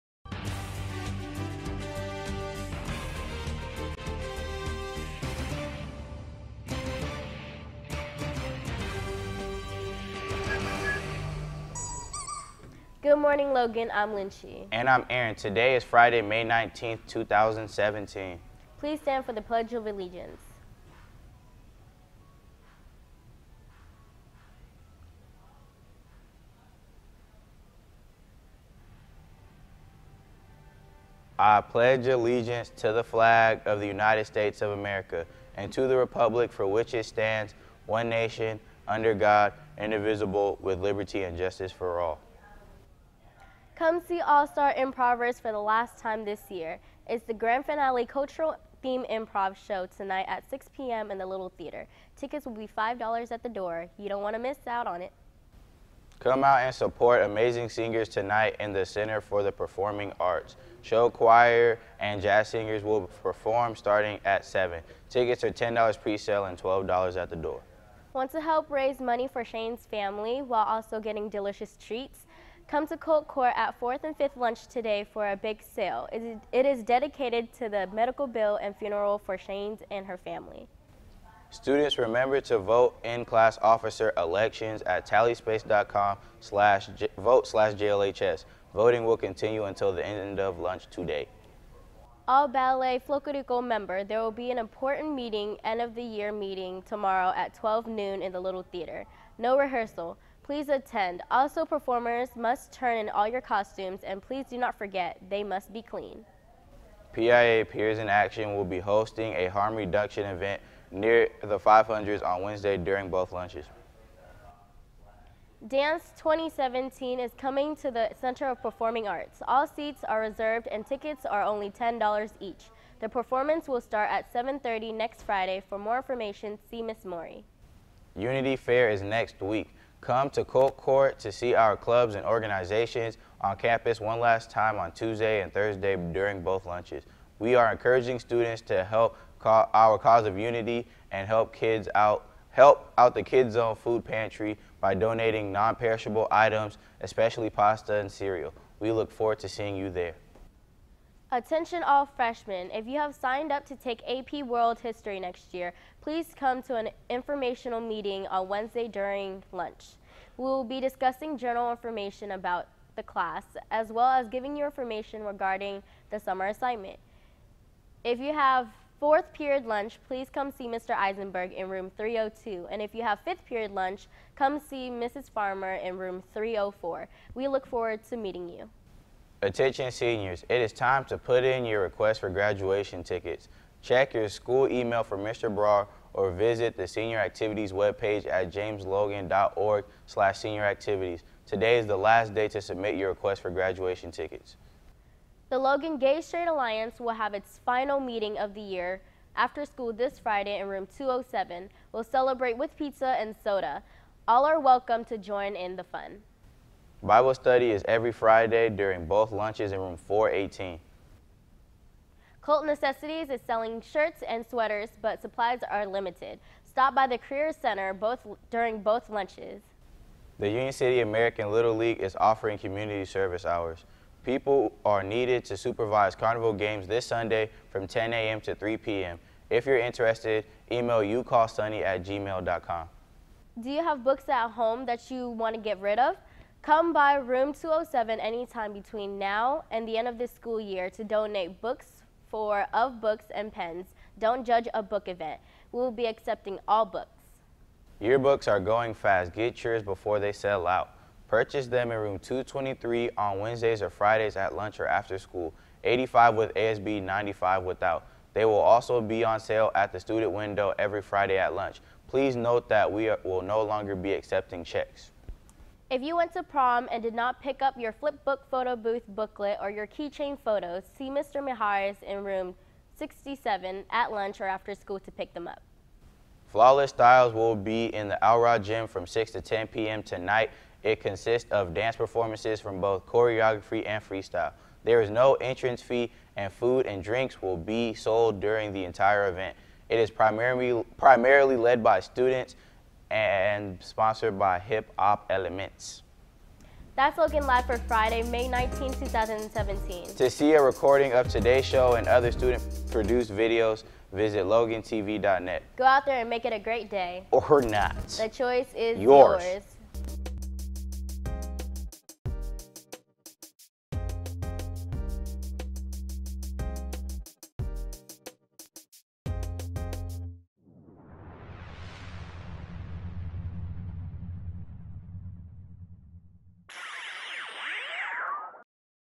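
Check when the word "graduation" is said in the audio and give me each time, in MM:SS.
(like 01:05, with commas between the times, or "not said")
03:02, 03:13.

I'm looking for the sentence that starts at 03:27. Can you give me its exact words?
Bible study is every Friday during both lunches in room 418.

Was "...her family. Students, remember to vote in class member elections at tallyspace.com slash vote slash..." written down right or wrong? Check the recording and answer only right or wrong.
wrong.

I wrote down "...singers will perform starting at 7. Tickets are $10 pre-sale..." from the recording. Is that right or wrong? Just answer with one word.
right.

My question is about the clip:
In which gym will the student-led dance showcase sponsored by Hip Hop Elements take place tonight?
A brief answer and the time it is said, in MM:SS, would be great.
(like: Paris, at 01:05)
Alrod Gym, at 04:38.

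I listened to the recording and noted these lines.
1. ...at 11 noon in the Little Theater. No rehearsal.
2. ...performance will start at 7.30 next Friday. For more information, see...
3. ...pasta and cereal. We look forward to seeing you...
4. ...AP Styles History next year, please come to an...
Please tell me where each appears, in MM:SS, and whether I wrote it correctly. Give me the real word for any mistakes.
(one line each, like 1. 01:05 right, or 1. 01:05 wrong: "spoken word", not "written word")
1. 01:37 wrong: "12", not "11"
2. 02:03 right
3. 02:27 right
4. 02:34 wrong: "World", not "Styles".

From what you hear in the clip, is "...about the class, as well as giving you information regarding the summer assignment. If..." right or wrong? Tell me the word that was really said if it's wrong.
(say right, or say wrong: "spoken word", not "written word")
right.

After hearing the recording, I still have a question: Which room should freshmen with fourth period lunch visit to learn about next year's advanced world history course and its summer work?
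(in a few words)
302.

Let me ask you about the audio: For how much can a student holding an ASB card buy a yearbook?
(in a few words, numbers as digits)
$85.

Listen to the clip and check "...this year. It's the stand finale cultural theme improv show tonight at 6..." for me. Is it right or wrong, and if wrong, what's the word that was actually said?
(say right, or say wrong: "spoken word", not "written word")
wrong: "grand", not "stand".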